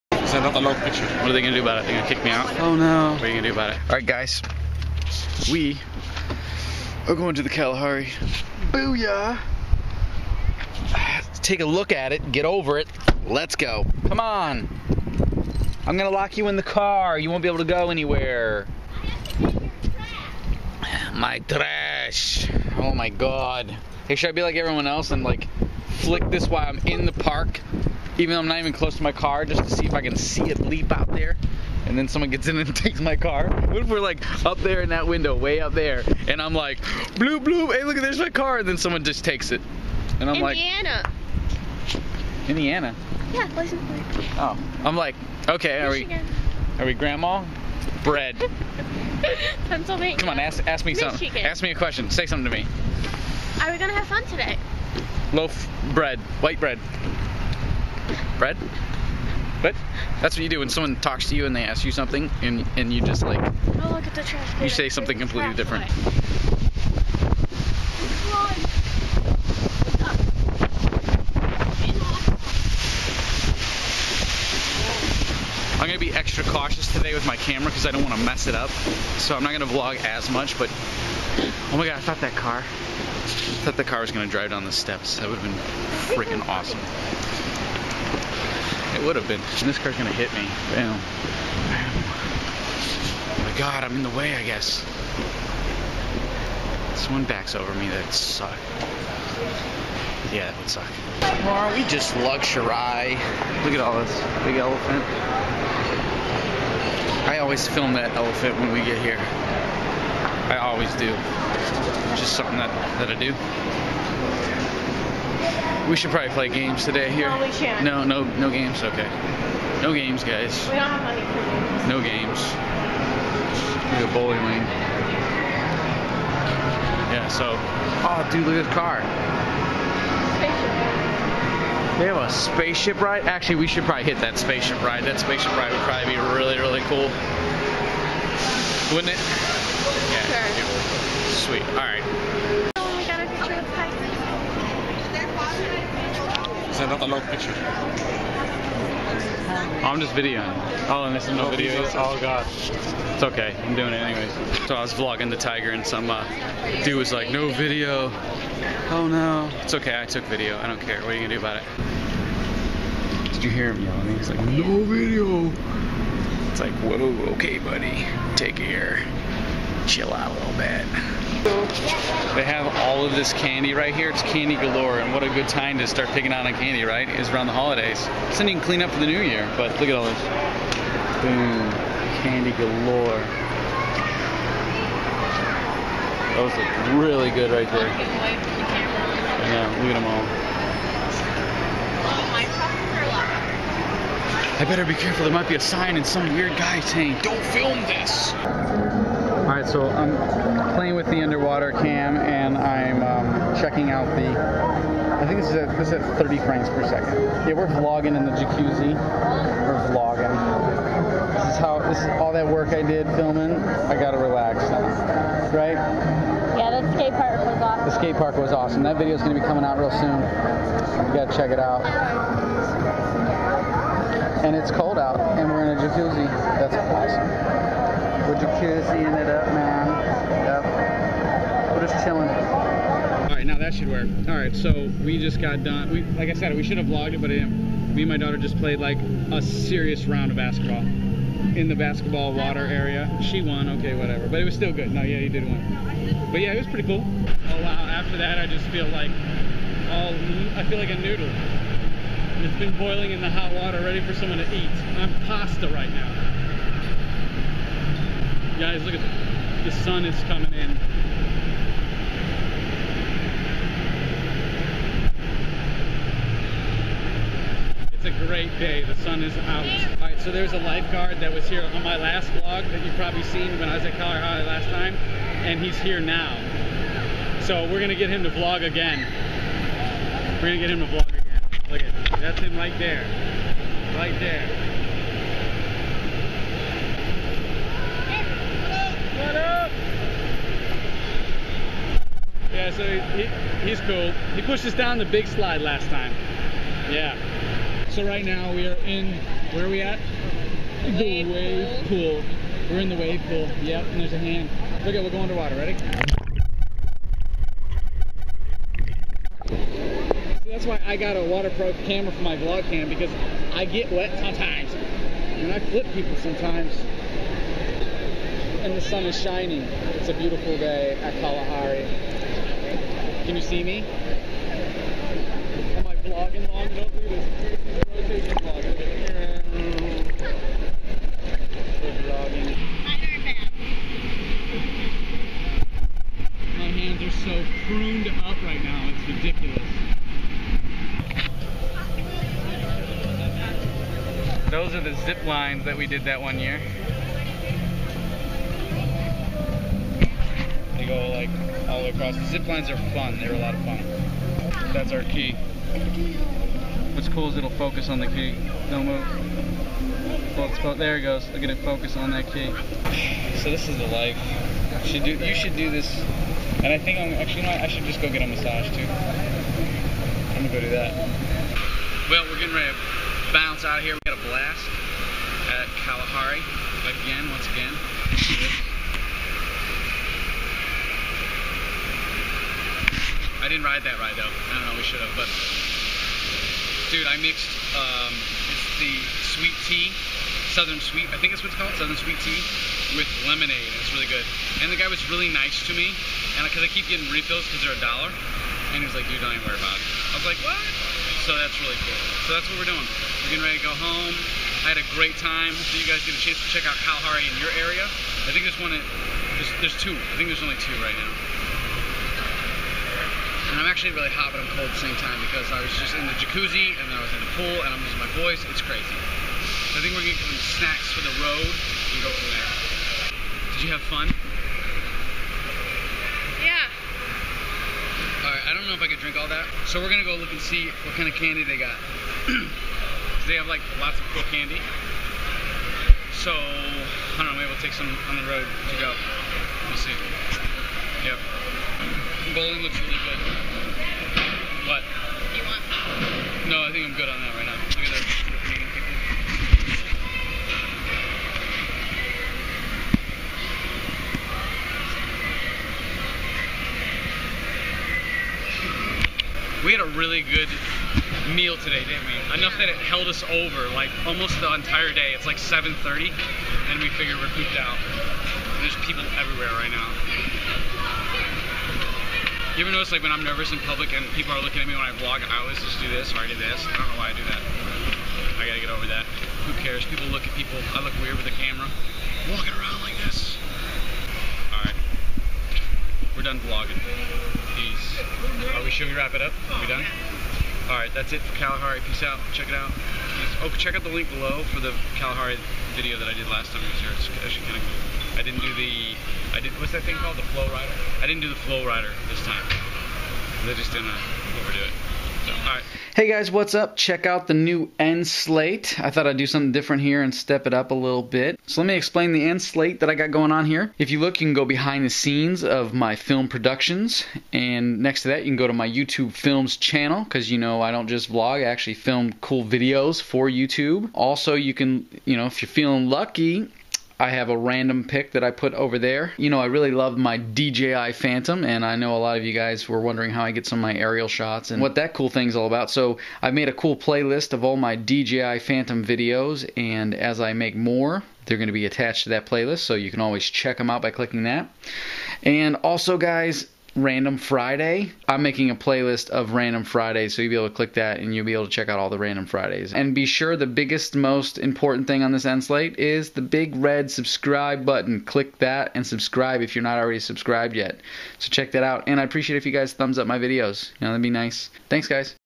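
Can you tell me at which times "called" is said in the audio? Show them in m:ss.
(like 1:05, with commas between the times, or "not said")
6:31, 8:19.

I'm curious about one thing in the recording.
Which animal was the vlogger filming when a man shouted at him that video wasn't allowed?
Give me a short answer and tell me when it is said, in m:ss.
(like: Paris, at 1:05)
Tiger, at 2:35.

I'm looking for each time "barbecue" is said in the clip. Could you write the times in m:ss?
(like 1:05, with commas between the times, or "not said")
not said.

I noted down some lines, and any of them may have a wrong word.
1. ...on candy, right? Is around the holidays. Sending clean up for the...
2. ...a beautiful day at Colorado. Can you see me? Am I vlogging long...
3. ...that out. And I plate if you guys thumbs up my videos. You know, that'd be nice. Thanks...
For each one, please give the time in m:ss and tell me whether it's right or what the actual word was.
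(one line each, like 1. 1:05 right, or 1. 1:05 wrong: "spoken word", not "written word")
1. 2:56 right
2. 5:20 wrong: "Kalahari", not "Colorado"
3. 9:21 wrong: "appreciate", not "plate".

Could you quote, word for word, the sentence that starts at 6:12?
Well, we're getting ready to bounce out of here.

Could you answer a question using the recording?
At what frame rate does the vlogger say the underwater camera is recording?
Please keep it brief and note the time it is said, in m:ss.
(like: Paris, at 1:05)
30 frames per second, at 3:26.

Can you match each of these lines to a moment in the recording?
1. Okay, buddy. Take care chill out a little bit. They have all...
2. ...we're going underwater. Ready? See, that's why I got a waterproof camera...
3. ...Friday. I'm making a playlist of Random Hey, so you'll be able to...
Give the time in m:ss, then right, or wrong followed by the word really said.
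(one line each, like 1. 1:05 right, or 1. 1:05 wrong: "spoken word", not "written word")
1. 2:47 right
2. 5:05 right
3. 9:07 wrong: "Fridays", not "Hey".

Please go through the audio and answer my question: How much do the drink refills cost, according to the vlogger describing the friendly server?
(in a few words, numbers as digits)
$1.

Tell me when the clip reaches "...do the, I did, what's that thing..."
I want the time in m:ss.
8:18.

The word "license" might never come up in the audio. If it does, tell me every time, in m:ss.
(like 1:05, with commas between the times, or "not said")
0:43.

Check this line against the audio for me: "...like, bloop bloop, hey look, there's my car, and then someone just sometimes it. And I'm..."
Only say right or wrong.
wrong.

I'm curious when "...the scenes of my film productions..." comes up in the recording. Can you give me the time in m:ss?
8:34.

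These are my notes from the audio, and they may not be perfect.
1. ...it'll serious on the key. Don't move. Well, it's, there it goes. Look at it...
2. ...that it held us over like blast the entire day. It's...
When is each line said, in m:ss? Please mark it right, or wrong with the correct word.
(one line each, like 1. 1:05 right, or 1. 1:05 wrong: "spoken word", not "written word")
1. 5:57 wrong: "focus", not "serious"
2. 7:42 wrong: "almost", not "blast".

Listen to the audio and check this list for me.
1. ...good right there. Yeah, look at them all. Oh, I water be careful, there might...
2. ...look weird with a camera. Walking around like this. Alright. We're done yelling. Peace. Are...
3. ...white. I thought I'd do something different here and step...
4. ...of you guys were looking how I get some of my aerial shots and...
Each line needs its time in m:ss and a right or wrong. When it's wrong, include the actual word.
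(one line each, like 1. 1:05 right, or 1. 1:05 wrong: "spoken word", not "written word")
1. 3:07 wrong: "better", not "water"
2. 8:00 wrong: "vlogging", not "yelling"
3. 8:28 wrong: "slate", not "white"
4. 8:52 wrong: "wondering", not "looking".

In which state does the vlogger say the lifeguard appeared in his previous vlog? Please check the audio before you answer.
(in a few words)
Colorado.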